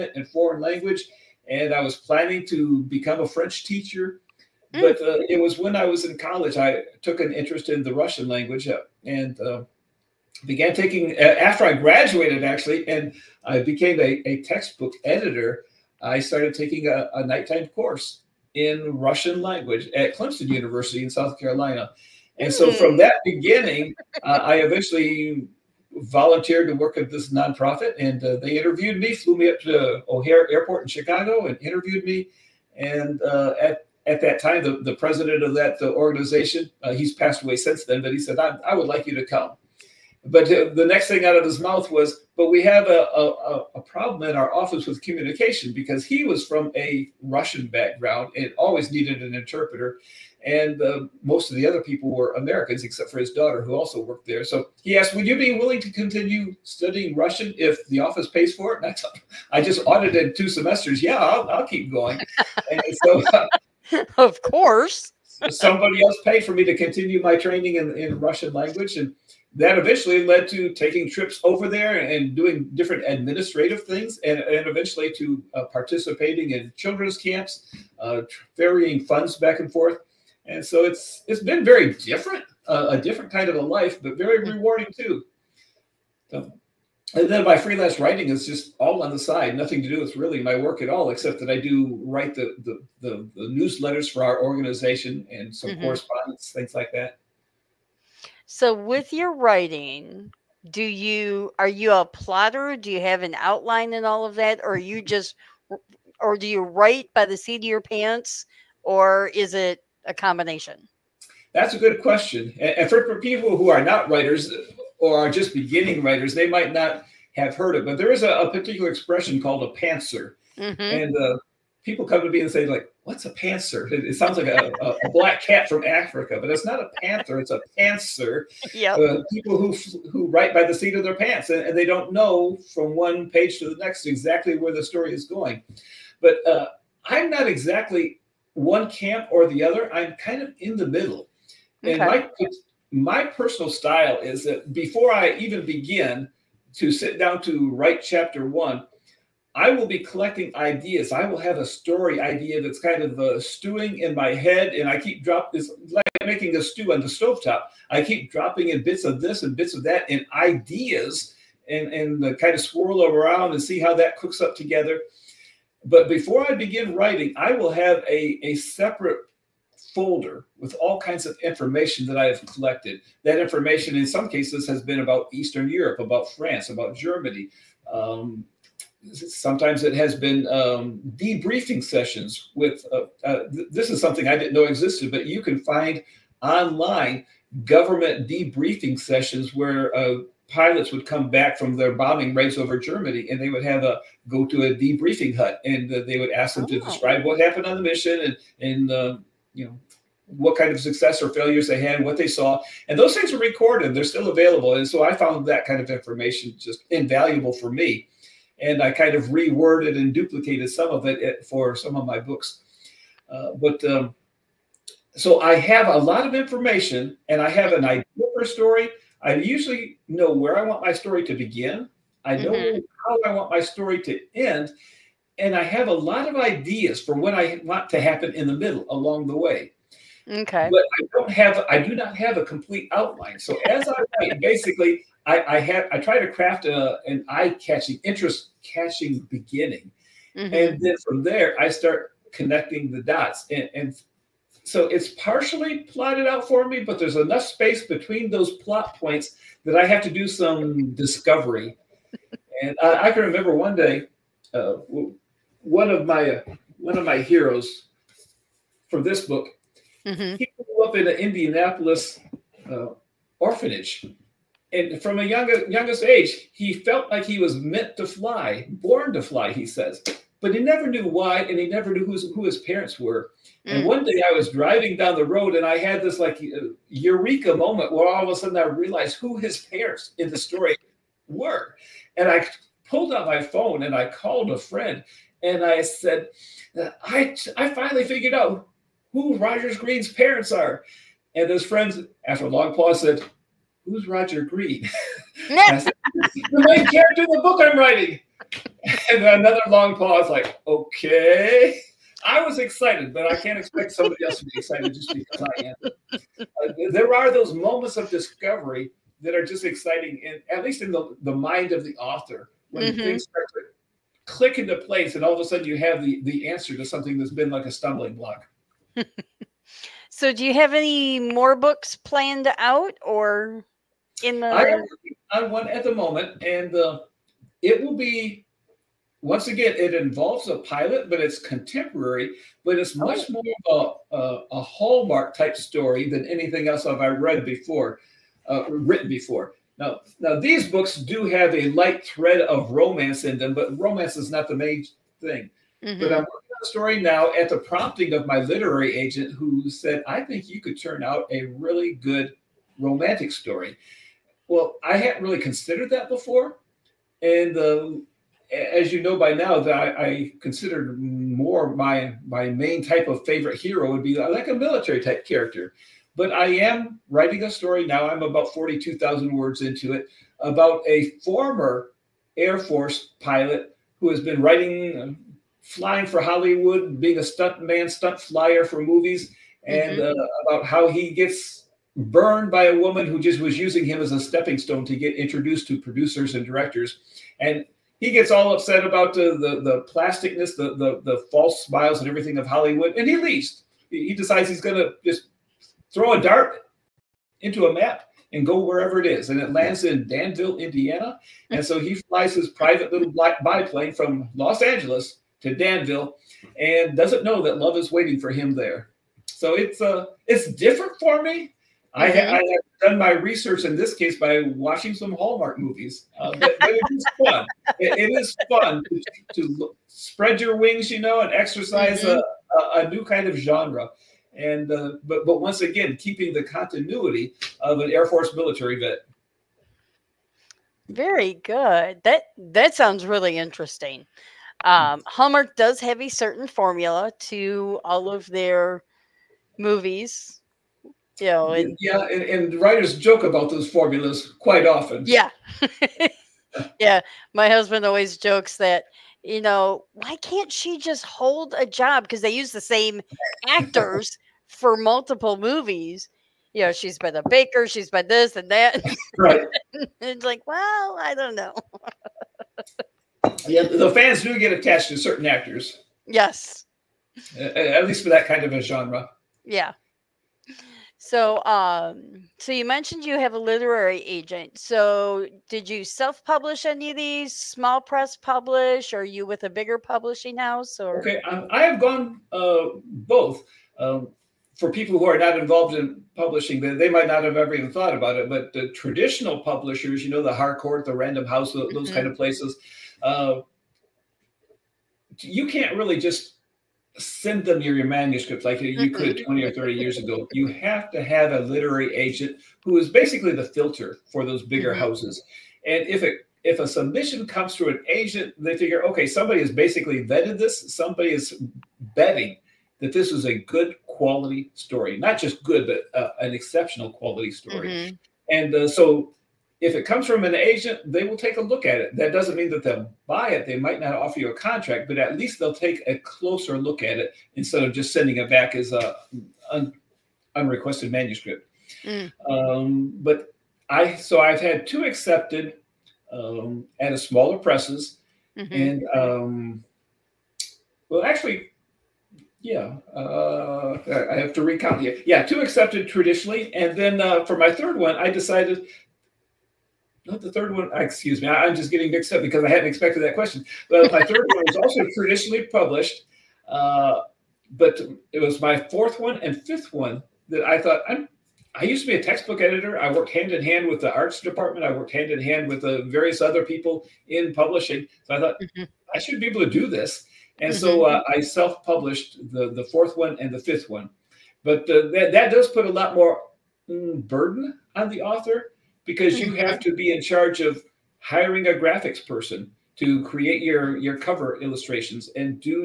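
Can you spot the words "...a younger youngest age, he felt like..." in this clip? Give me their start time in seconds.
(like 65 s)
265 s.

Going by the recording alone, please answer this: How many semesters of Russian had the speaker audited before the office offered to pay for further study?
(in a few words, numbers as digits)
2.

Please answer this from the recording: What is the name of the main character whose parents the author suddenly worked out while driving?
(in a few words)
Roger Greene.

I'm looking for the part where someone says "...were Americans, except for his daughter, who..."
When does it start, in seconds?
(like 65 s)
52 s.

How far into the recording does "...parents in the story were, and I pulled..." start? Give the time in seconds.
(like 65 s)
279 s.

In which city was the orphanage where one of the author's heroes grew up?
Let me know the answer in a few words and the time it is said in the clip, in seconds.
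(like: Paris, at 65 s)
Indianapolis, at 261 s.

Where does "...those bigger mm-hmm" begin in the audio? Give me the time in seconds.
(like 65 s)
504 s.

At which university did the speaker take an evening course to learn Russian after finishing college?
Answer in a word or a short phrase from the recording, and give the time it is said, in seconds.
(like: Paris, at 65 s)
Clemson University, at 20 s.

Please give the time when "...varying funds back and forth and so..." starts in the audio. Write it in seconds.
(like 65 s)
78 s.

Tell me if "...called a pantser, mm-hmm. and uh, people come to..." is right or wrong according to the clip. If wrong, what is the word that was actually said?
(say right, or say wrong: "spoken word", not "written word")
right.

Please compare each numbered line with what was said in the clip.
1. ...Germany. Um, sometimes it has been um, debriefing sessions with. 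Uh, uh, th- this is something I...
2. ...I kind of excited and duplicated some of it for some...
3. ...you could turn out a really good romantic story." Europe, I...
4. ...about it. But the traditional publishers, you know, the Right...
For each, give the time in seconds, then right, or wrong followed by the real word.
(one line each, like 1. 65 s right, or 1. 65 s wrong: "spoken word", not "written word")
1. 176 s right
2. 208 s wrong: "reworded", not "excited"
3. 350 s wrong: "Well", not "Europe"
4. 487 s wrong: "Harcourt", not "Right".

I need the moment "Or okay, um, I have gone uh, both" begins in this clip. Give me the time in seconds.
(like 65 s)
480 s.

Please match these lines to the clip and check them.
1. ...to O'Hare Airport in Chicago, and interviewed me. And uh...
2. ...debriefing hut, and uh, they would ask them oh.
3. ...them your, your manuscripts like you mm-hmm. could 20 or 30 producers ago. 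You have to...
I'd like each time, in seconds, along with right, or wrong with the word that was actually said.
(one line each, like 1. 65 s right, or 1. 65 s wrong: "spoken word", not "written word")
1. 29 s right
2. 194 s right
3. 497 s wrong: "years", not "producers".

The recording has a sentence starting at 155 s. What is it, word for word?
this like making a stew on the stove top.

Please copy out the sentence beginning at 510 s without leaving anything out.
Somebody is betting that this is a good quality story, not just good, but uh, an exceptional quality story.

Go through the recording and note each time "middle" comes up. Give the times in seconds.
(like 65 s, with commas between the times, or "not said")
140 s, 228 s.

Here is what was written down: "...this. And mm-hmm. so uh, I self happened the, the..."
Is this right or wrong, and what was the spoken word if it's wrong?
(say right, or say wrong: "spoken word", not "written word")
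wrong: "published", not "happened".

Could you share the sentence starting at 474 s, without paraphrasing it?
So, did you self-publish any of these?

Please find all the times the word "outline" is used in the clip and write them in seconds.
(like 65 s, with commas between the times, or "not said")
103 s, 232 s.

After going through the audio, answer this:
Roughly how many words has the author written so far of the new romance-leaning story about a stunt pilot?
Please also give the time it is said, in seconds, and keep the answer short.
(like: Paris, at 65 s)
42,000, at 368 s.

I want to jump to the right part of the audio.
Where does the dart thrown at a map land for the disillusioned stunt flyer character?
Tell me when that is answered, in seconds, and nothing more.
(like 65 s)
400 s.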